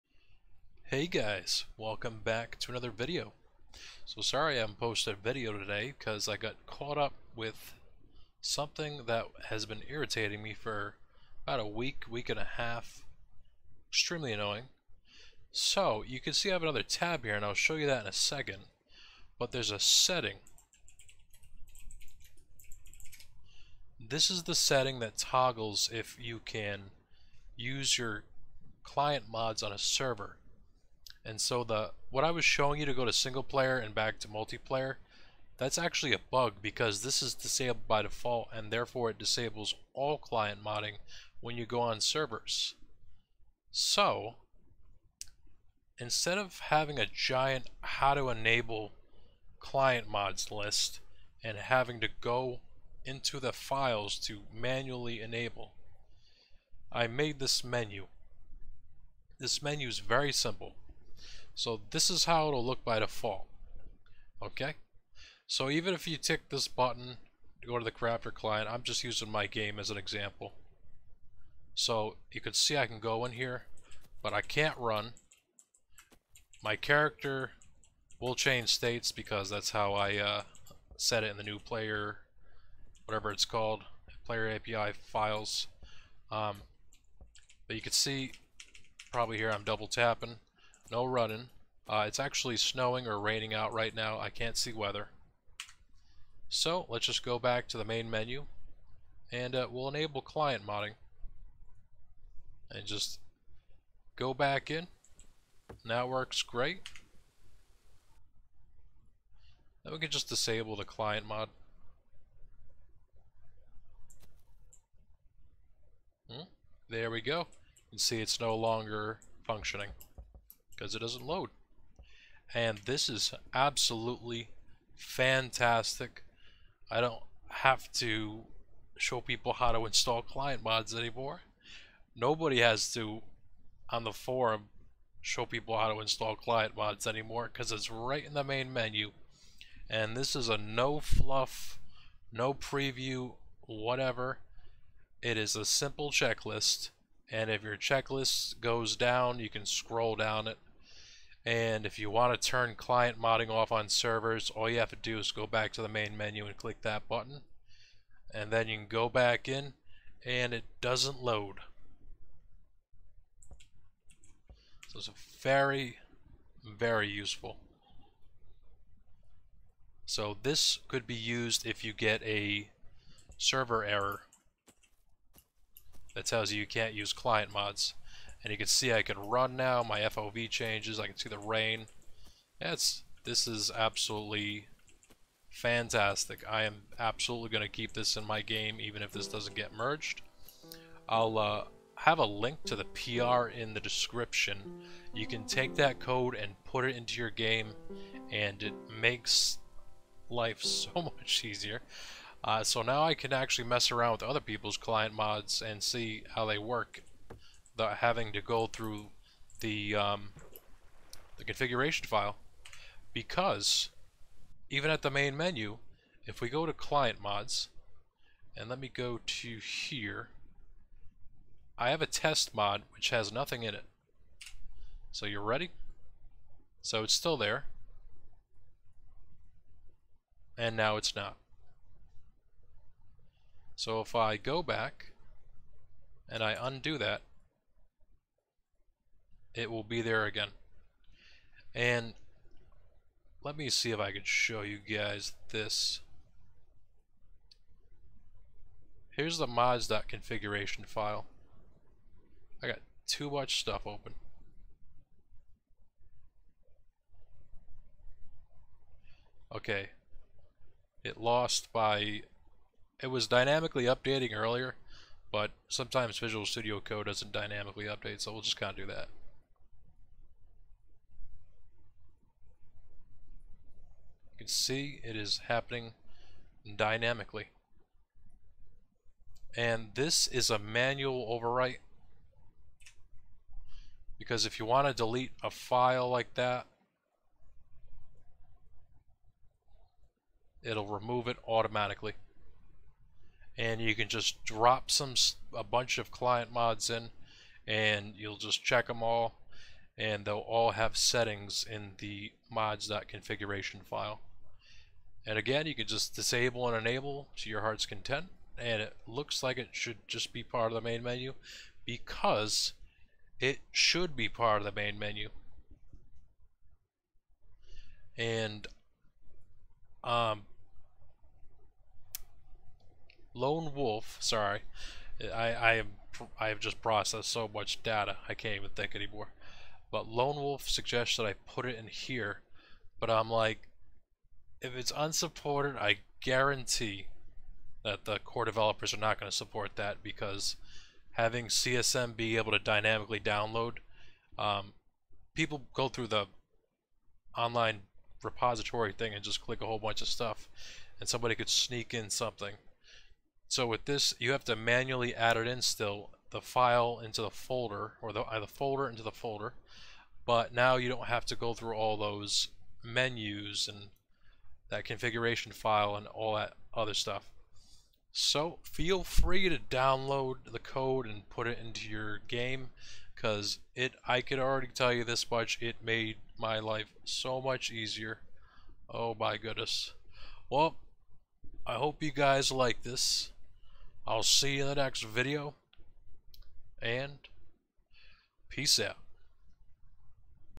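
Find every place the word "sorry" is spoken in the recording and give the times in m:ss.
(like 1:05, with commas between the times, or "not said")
0:04, 5:24.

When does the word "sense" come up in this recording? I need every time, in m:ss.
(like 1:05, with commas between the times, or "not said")
not said.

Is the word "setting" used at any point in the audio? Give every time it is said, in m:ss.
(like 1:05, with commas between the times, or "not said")
0:19, 0:24, 5:00.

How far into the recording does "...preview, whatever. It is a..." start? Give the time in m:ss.
2:22.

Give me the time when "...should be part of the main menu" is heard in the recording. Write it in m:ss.
5:13.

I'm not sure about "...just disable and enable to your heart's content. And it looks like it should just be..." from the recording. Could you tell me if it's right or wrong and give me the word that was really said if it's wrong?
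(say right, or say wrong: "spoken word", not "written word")
right.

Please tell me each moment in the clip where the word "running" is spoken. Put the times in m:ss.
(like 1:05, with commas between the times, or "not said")
1:31.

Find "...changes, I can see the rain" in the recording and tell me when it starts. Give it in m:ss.
3:00.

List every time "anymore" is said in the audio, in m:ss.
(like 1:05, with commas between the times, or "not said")
2:10, 2:17, 5:28.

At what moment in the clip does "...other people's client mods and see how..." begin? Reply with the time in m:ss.
3:24.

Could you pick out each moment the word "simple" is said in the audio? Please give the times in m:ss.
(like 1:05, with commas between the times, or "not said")
1:00, 2:25.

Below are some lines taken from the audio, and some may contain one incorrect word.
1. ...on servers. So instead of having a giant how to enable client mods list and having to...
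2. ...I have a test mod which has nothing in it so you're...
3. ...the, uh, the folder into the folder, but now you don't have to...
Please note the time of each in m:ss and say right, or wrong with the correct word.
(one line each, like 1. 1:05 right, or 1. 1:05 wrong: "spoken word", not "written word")
1. 0:41 right
2. 3:41 right
3. 5:58 right.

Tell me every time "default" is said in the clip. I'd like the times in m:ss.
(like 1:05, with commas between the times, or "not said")
0:38, 1:02.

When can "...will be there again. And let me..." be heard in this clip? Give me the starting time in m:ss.
3:59.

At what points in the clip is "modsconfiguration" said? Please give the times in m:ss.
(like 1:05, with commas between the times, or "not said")
4:09, 5:02.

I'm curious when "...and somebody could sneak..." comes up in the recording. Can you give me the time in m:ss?
5:50.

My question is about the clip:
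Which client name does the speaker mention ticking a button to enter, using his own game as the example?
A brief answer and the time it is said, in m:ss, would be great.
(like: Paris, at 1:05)
Crafter, at 1:07.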